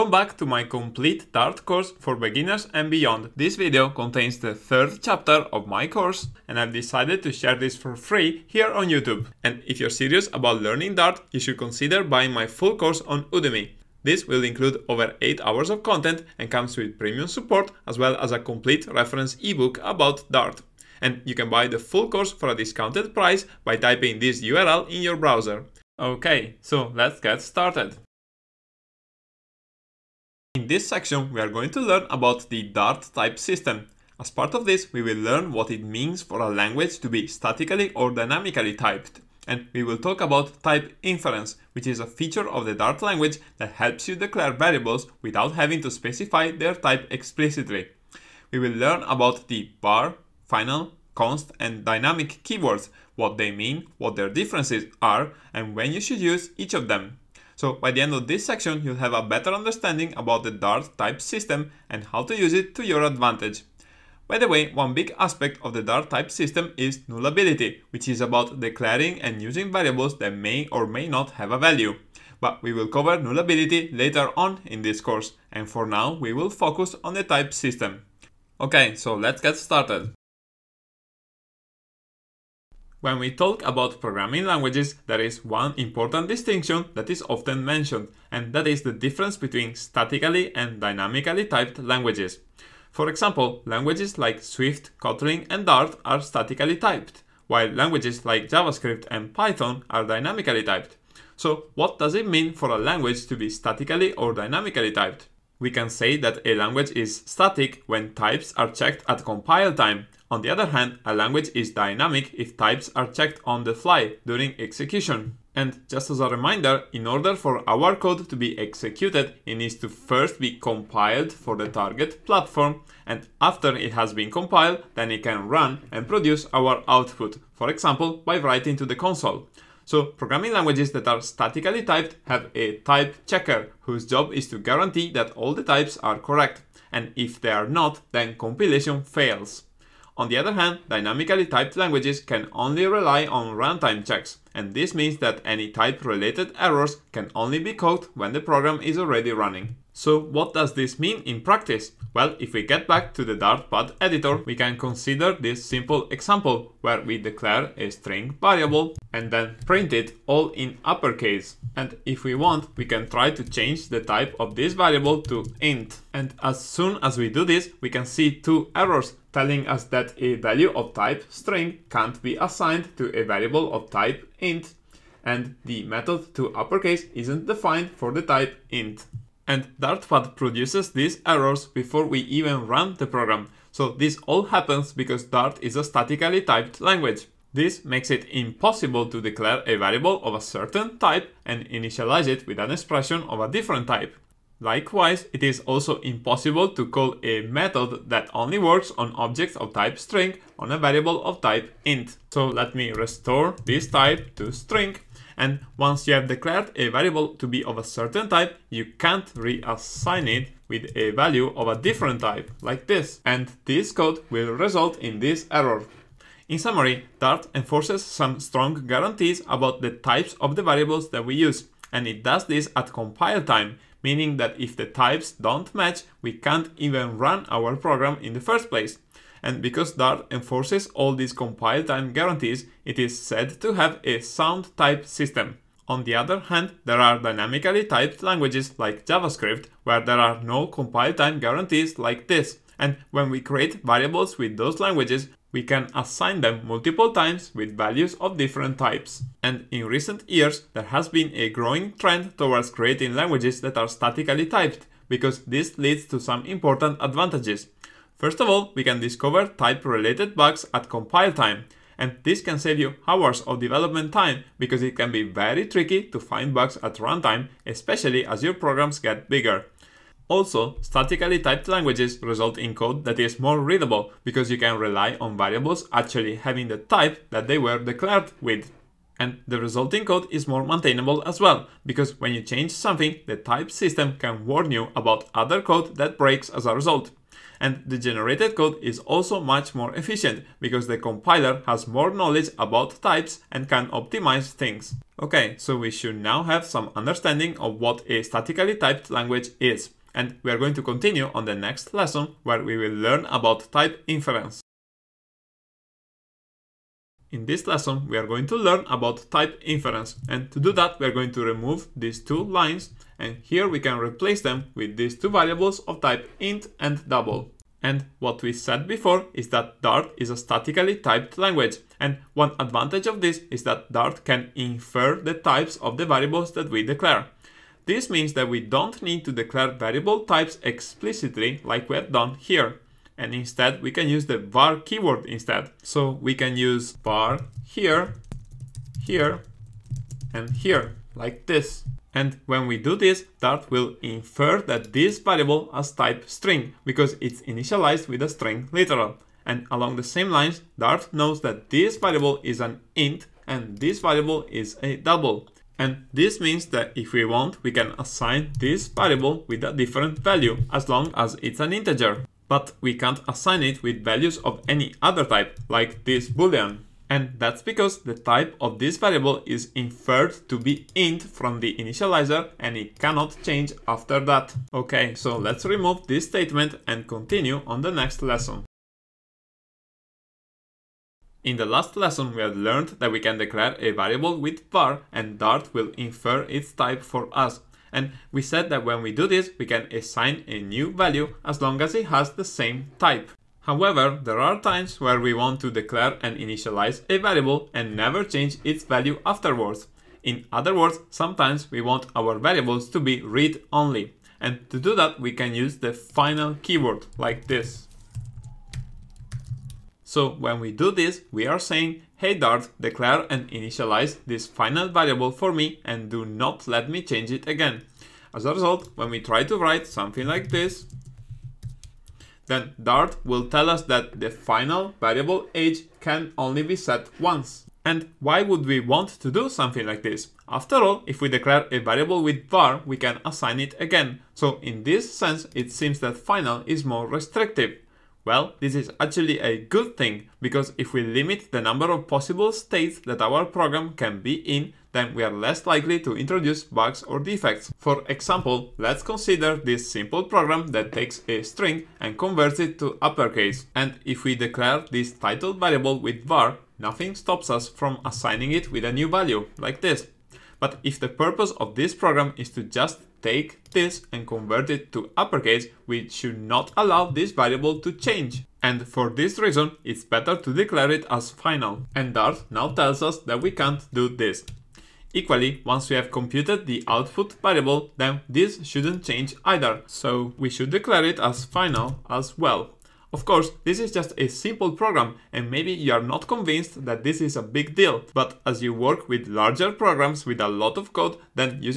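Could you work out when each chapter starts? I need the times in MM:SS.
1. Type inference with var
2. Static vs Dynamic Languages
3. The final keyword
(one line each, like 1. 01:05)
1. 05:05
2. 01:20
3. 06:19.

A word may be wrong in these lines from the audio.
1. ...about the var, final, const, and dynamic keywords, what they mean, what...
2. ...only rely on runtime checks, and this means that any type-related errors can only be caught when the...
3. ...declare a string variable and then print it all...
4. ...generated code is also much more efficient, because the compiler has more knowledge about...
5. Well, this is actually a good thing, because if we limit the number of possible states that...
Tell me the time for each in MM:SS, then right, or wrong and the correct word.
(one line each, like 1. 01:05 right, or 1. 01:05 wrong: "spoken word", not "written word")
1. 00:49 right
2. 02:22 right
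3. 02:37 right
4. 04:47 right
5. 07:18 right.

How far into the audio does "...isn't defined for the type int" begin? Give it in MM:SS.
02:57.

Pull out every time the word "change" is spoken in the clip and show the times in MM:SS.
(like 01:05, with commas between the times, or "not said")
02:43, 04:42, 06:13, 06:38, 06:57, 07:47, 07:59.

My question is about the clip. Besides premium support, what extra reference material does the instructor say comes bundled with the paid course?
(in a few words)
A complete reference ebook.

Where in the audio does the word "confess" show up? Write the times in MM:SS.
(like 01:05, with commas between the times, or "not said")
not said.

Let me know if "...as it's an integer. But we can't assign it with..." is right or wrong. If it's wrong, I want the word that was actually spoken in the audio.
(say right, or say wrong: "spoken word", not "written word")
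right.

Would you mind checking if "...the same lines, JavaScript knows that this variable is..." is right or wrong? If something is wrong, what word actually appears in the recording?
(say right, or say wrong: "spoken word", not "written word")
wrong: "Dart", not "JavaScript".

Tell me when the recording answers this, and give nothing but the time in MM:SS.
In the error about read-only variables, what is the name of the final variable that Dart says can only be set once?
07:05.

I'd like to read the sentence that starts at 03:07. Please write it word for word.
This makes it impossible to declare a variable of a certain type and initialize it with an expression of a different type.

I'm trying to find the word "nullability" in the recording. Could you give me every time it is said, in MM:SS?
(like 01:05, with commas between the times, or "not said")
01:07, 01:13.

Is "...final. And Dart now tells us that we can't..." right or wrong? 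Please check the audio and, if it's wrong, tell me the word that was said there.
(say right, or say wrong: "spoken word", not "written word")
right.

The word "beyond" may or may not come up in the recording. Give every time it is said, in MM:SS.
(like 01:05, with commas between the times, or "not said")
00:02.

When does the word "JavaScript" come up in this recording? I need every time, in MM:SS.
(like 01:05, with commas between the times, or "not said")
01:38, 03:59.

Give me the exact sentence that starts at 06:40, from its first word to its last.
In other words, sometimes we want our variables to be read-only.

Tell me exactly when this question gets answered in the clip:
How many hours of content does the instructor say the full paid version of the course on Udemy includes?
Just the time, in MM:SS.
00:14.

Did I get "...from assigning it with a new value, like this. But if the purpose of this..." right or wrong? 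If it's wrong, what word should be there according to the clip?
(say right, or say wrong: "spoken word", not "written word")
right.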